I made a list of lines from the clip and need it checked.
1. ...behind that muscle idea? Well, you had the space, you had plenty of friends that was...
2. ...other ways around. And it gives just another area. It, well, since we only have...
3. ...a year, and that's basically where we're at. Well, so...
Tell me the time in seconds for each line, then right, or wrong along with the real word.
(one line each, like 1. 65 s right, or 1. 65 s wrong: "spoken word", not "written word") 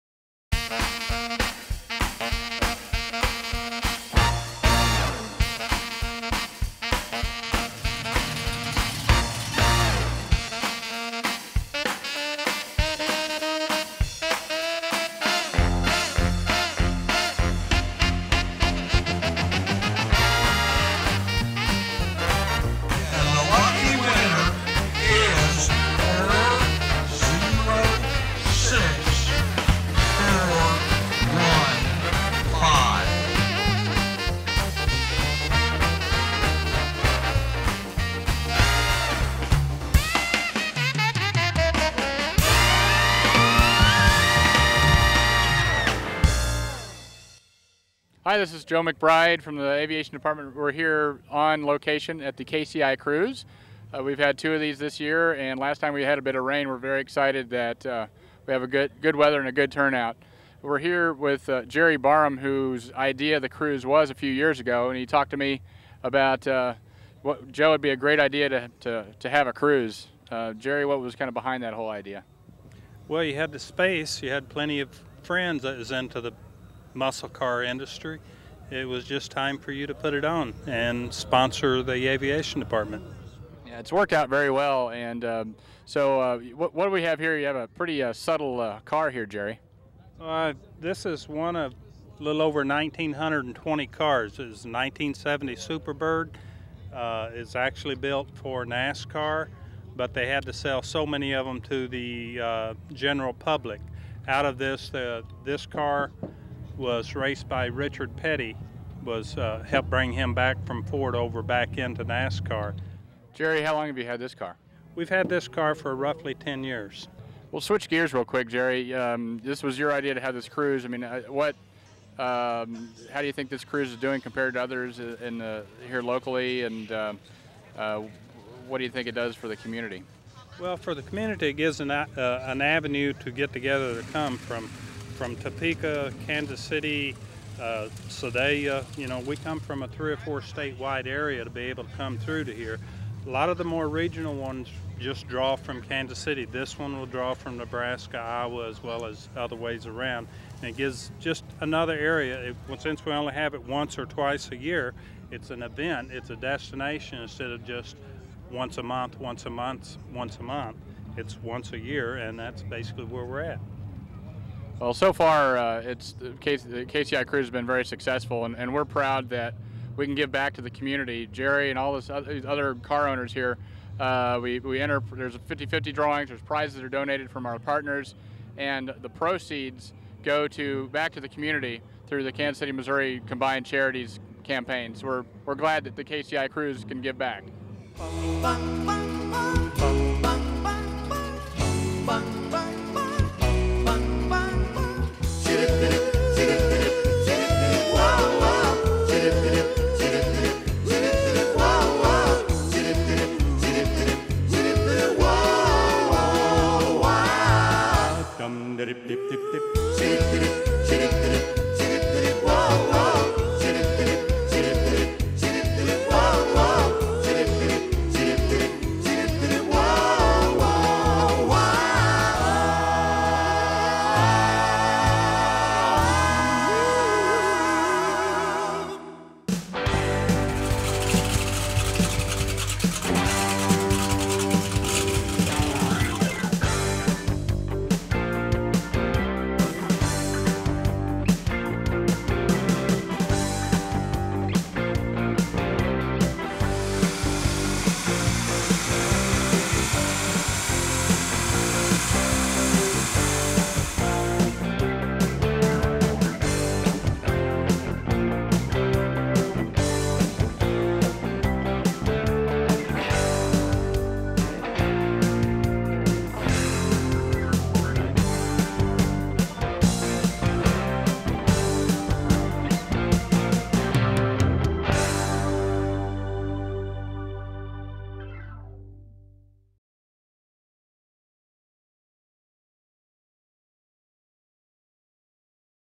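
1. 71 s wrong: "whole", not "muscle"
2. 149 s right
3. 161 s right.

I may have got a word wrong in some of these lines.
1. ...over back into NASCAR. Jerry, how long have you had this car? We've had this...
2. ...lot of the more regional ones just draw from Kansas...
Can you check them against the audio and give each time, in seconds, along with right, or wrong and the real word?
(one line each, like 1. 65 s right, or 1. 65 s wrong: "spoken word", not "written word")
1. 111 s right
2. 143 s right.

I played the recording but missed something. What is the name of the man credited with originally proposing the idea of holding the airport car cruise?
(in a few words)
Jerry Barham.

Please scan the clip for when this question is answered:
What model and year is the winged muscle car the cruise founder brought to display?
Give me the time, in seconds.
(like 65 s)
94 s.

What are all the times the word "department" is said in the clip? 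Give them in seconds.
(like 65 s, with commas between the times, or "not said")
50 s, 82 s.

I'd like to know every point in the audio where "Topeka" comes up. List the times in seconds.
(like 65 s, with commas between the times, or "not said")
135 s.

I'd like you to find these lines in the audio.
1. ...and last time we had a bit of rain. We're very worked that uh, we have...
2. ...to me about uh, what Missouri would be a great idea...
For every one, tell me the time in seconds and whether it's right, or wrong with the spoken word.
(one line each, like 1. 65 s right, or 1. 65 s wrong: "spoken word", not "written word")
1. 55 s wrong: "excited", not "worked"
2. 65 s wrong: "Joe", not "Missouri".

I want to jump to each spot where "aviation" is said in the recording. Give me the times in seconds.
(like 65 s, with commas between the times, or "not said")
49 s, 82 s.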